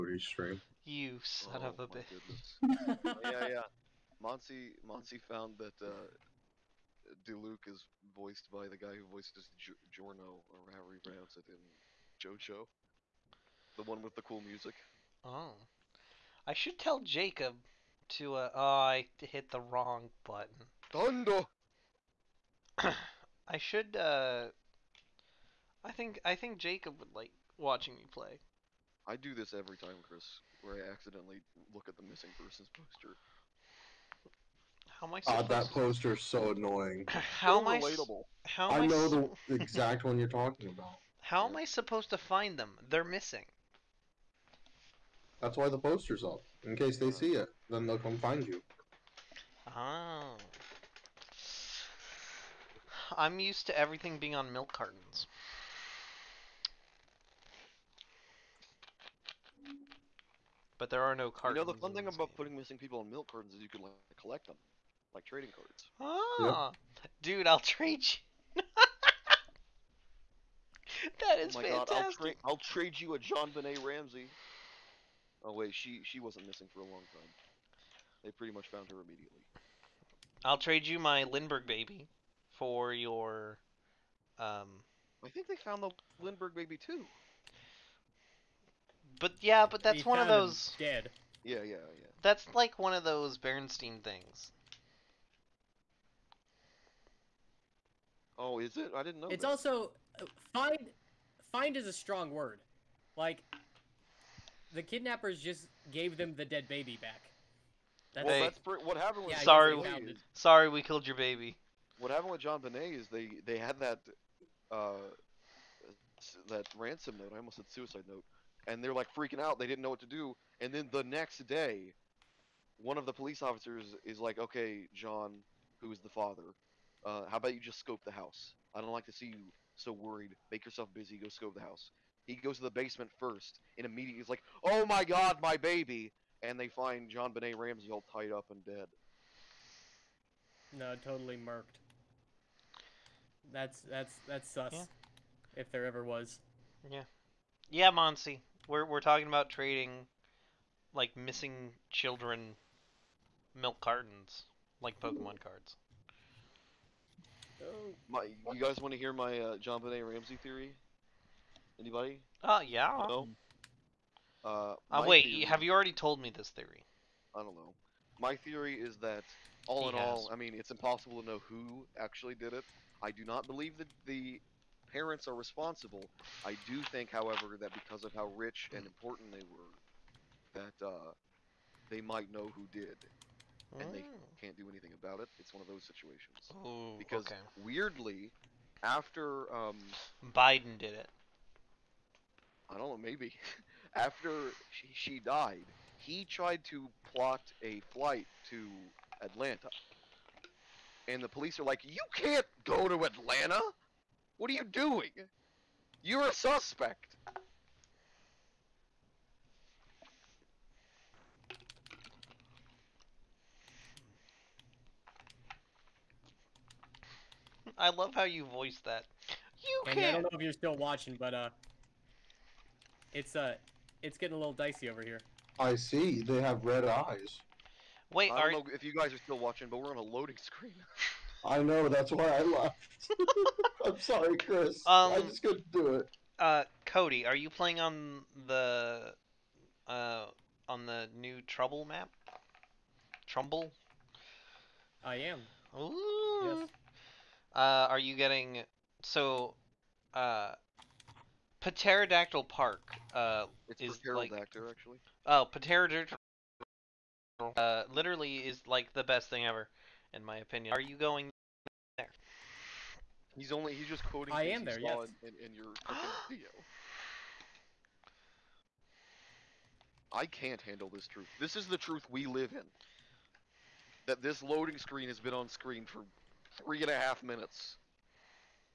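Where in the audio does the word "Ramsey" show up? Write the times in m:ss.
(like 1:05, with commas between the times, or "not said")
1:13, 2:17, 2:40.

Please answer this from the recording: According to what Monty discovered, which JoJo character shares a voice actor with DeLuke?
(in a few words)
Jorno.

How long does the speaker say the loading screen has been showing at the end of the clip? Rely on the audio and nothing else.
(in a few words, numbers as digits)
3.5 minutes.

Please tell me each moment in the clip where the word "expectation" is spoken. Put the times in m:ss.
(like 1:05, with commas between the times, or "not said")
not said.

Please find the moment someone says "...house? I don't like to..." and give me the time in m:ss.
2:08.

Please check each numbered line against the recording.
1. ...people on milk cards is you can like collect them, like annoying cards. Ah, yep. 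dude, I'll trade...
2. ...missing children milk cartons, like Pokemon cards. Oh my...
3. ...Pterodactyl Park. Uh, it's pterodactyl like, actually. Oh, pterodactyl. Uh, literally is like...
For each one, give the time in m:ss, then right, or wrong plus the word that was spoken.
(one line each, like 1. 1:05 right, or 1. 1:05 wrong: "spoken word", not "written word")
1. 1:02 wrong: "trading", not "annoying"
2. 2:31 right
3. 4:11 right.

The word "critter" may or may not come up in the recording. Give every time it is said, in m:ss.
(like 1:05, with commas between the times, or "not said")
not said.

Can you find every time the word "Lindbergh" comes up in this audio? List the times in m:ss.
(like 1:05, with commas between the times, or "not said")
1:21, 1:26.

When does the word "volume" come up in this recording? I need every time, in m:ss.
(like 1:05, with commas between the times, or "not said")
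not said.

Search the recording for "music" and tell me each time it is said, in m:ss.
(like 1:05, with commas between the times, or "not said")
0:14.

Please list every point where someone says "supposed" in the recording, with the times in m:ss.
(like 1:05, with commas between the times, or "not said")
0:35, 0:41.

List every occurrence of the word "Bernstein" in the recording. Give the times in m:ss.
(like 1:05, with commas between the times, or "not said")
1:33.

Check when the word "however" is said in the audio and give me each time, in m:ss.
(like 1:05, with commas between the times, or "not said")
0:10, 2:57.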